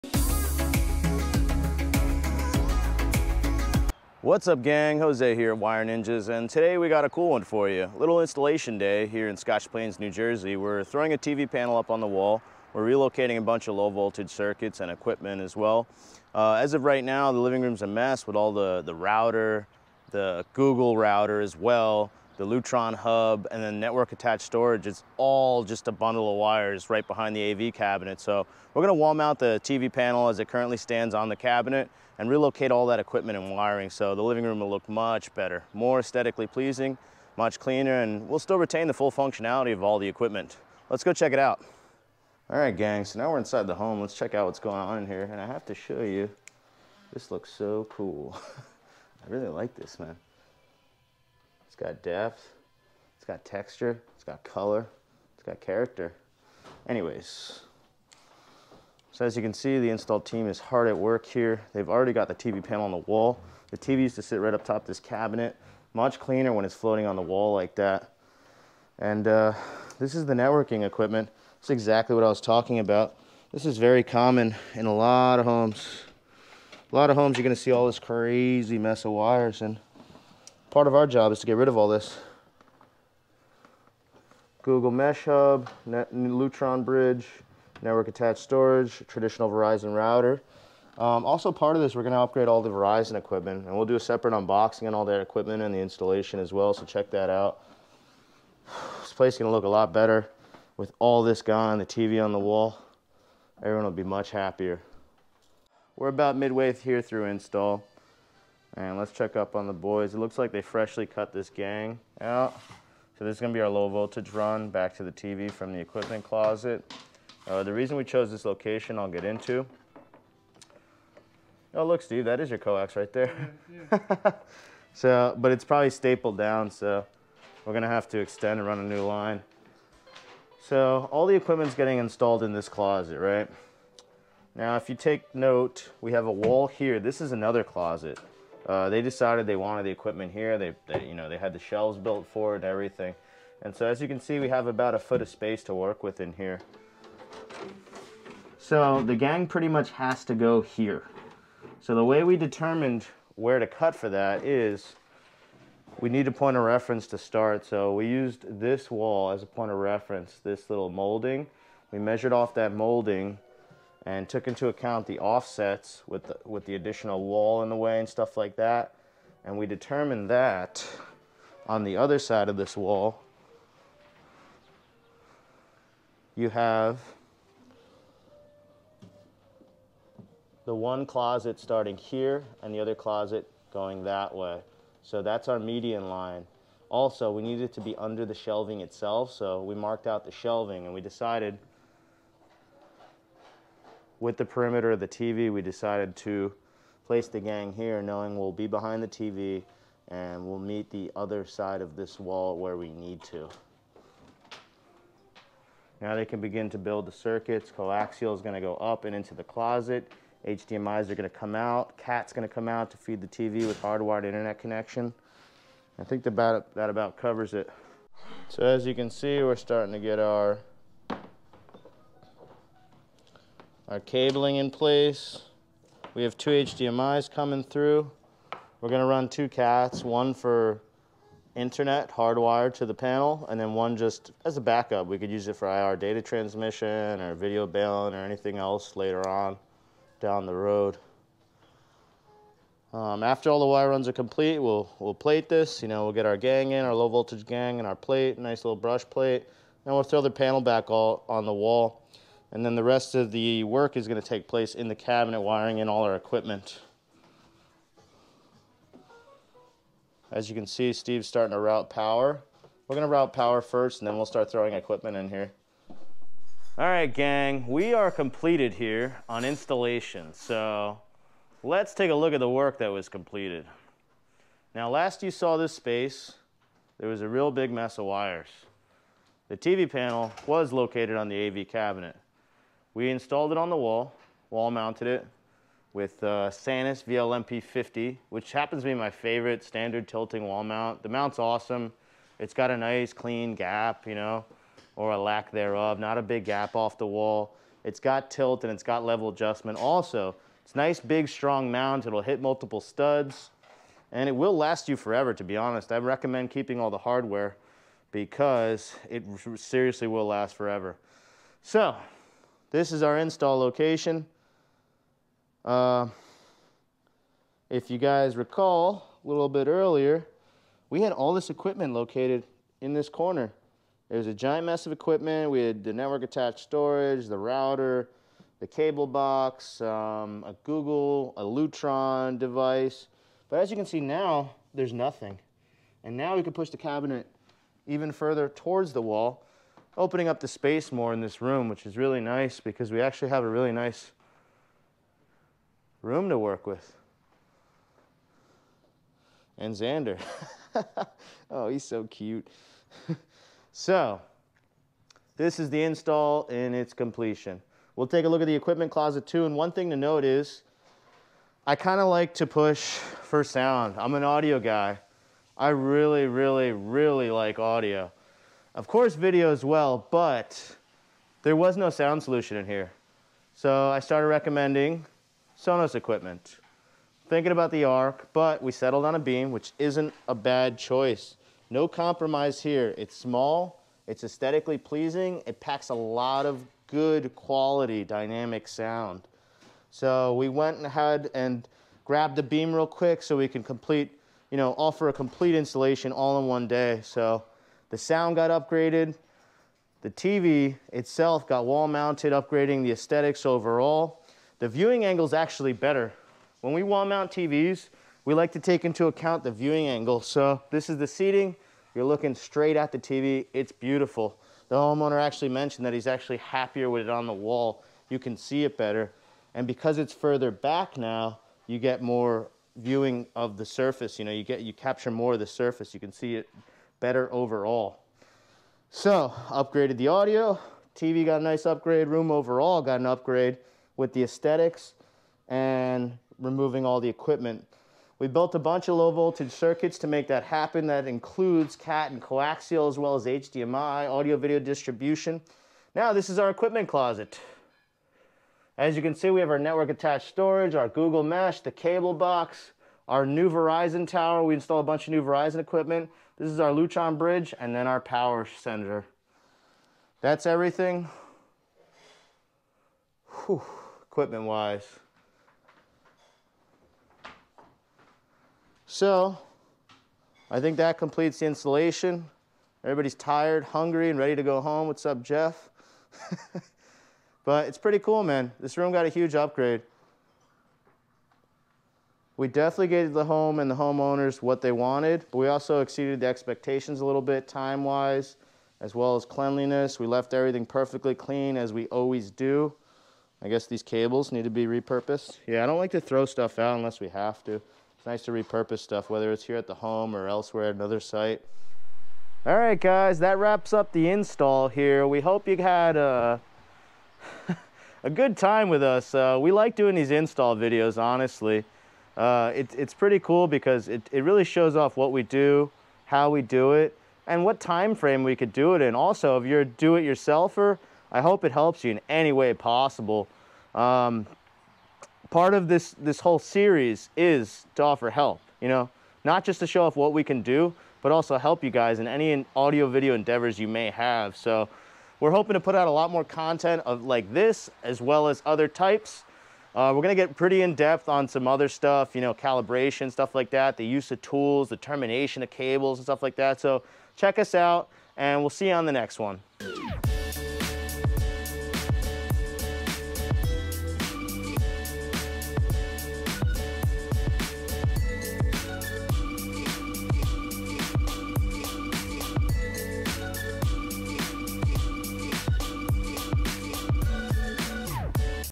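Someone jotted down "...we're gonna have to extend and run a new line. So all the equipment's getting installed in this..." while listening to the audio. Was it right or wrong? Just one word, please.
right.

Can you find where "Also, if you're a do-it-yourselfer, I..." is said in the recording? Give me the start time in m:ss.
8:38.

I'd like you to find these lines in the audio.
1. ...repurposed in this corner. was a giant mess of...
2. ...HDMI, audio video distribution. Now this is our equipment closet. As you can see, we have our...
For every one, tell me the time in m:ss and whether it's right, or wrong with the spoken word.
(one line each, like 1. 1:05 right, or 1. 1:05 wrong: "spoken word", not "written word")
1. 5:21 wrong: "located", not "repurposed"
2. 7:23 right.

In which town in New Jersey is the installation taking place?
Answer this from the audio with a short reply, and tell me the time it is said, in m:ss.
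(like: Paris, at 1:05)
Scotch Plains, at 0:09.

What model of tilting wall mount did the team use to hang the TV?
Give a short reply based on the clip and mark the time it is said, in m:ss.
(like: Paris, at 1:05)
Sanus VLMP50, at 4:46.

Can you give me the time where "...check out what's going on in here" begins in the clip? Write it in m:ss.
0:44.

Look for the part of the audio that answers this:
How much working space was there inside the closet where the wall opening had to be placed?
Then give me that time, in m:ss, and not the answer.
2:24.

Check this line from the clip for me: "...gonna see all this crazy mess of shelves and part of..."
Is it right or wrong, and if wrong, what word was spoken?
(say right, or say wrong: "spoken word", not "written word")
wrong: "wires", not "shelves".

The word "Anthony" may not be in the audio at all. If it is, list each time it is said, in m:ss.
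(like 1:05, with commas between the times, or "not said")
not said.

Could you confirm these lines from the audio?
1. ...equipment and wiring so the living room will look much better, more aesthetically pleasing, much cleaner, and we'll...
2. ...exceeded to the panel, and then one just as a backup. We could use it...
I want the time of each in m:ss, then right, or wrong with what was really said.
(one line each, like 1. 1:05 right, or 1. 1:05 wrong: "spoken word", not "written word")
1. 0:32 right
2. 3:52 wrong: "hardwired", not "exceeded".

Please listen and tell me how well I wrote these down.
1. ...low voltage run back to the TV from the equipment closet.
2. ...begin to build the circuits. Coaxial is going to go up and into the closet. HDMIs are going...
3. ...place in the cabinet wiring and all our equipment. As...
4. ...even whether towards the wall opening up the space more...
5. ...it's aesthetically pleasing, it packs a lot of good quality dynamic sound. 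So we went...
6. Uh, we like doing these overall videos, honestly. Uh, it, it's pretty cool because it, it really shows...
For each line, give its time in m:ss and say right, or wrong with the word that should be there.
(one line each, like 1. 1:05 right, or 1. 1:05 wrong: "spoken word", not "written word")
1. 1:53 right
2. 3:26 right
3. 4:14 right
4. 5:37 wrong: "further", not "whether"
5. 6:24 right
6. 8:29 wrong: "install", not "overall".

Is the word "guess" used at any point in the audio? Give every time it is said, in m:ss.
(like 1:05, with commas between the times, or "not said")
8:13.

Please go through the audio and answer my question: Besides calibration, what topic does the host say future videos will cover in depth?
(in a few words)
termination of cables.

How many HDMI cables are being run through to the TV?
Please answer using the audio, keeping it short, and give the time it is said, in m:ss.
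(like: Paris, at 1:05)
2, at 3:46.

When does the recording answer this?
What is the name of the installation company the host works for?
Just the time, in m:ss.
0:05.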